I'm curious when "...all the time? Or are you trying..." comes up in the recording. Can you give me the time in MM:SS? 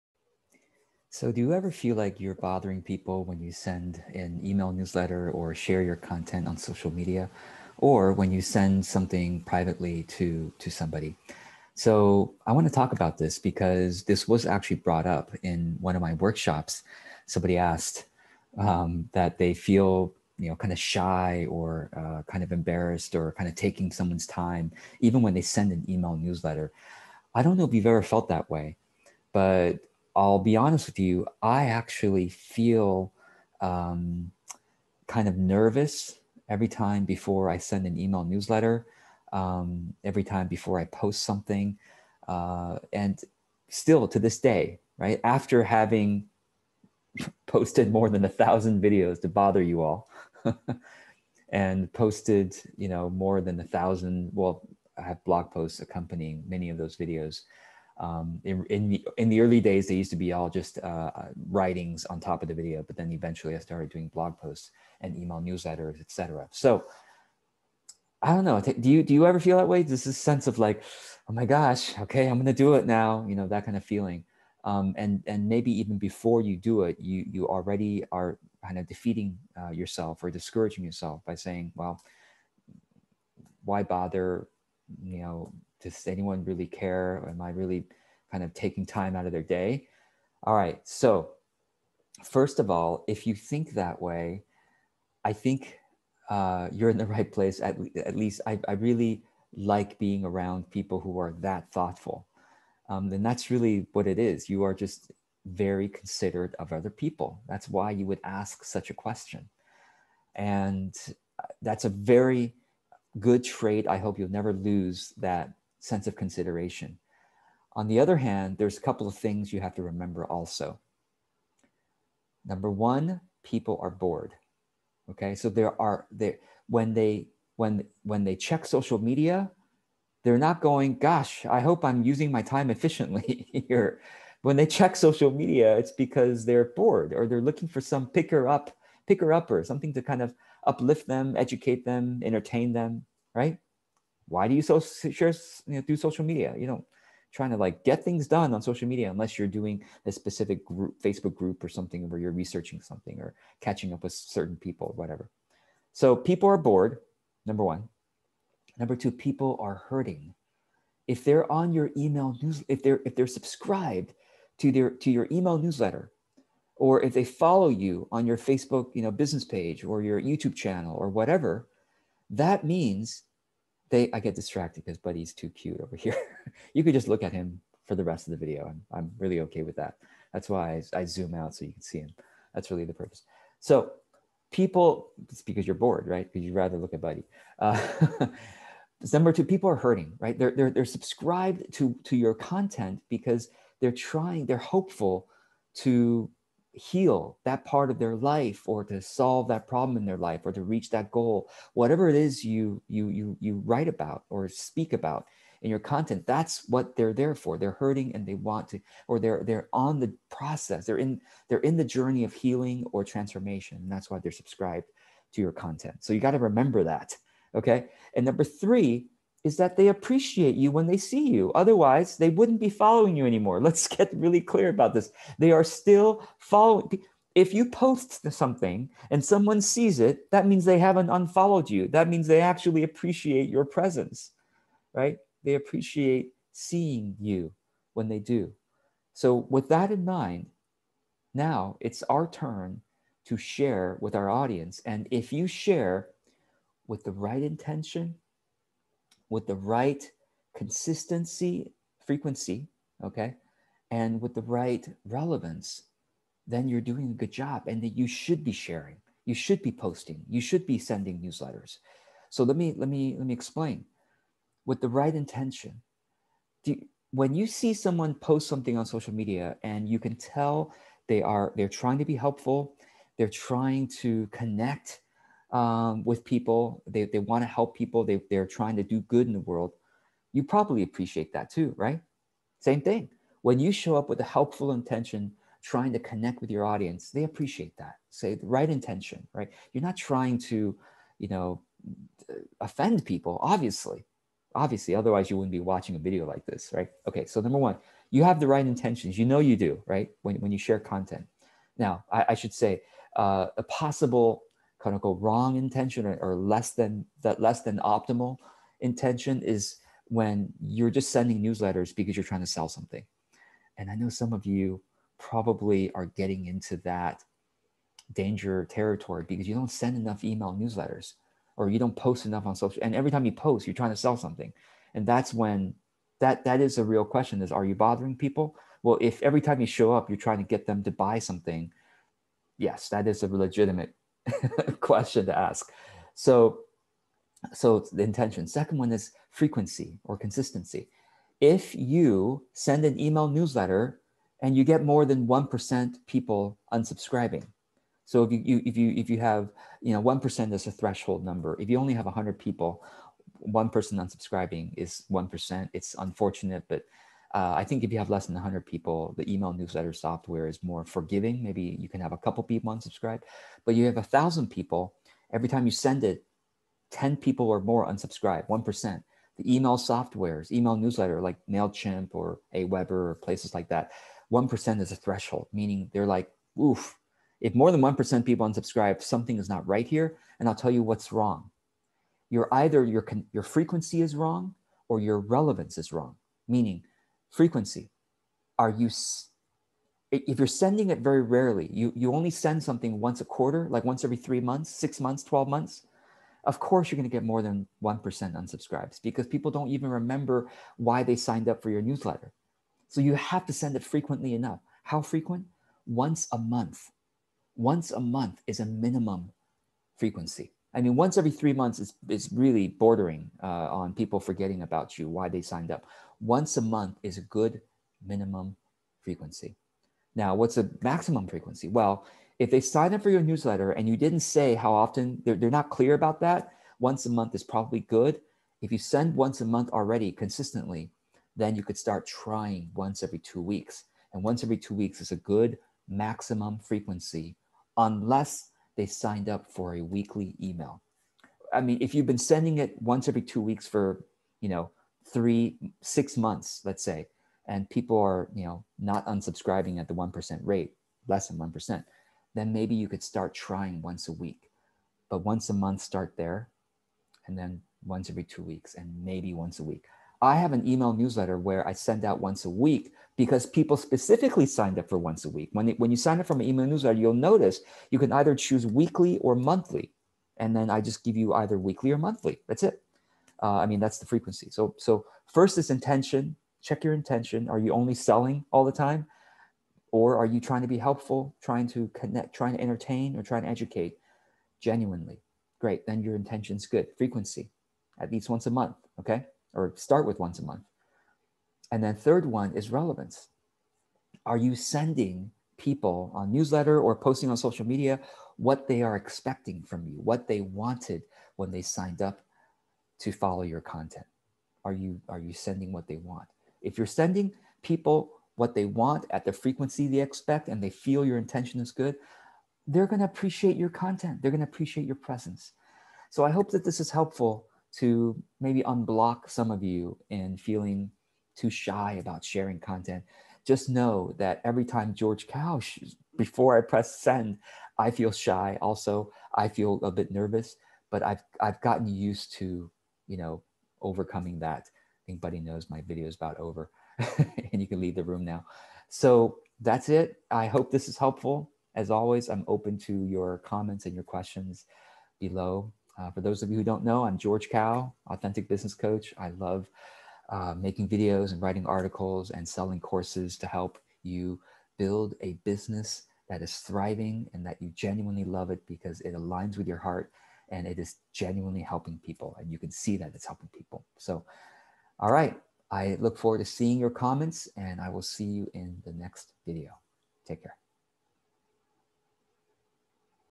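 07:58.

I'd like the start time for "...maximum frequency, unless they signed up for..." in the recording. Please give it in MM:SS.
07:15.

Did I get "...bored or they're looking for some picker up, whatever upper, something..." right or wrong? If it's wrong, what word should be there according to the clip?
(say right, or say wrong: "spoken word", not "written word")
wrong: "picker", not "whatever".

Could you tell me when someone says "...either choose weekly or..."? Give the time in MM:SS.
07:48.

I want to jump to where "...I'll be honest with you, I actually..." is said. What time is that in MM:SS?
00:30.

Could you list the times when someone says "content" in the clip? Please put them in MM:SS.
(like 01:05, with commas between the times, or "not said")
00:05, 03:12, 03:25, 03:35, 05:00, 08:23, 08:33, 08:42.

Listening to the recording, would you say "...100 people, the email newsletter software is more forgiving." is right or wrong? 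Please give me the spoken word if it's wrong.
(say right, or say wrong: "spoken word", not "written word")
right.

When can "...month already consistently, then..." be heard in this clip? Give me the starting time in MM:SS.
07:09.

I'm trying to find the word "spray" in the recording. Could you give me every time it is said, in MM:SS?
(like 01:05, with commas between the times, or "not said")
not said.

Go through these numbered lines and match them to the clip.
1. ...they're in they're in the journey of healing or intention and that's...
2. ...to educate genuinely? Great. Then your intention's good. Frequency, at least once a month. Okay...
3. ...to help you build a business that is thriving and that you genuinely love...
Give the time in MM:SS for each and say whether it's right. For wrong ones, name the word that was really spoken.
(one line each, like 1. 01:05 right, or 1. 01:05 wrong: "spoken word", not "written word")
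1. 03:30 wrong: "transformation", not "intention"
2. 08:03 right
3. 09:13 right.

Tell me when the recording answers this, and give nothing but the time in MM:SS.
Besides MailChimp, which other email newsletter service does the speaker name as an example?
06:12.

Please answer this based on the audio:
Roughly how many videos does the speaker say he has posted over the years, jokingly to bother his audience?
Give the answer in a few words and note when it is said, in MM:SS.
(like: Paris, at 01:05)
more than 1000, at 00:47.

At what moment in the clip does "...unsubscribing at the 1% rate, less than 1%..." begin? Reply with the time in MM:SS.
07:29.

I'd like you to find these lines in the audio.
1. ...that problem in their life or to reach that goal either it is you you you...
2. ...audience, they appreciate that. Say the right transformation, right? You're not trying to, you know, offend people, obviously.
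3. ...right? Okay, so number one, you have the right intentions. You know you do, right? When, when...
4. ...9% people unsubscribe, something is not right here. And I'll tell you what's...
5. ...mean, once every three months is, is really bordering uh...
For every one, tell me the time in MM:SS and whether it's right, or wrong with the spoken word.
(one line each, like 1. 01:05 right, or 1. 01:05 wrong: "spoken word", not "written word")
1. 03:19 wrong: "whatever", not "either"
2. 04:46 wrong: "intention", not "transformation"
3. 04:56 right
4. 06:17 wrong: "1", not "9"
5. 06:50 right.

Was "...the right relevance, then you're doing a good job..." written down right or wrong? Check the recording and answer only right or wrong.
right.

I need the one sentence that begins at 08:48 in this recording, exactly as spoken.
Also, I feel a bit nervous, but I've, I've gotten used to, you know, overcoming that.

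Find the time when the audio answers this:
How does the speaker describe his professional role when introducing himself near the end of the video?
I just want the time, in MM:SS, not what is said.
09:08.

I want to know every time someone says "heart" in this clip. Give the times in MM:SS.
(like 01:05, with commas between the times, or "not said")
09:19.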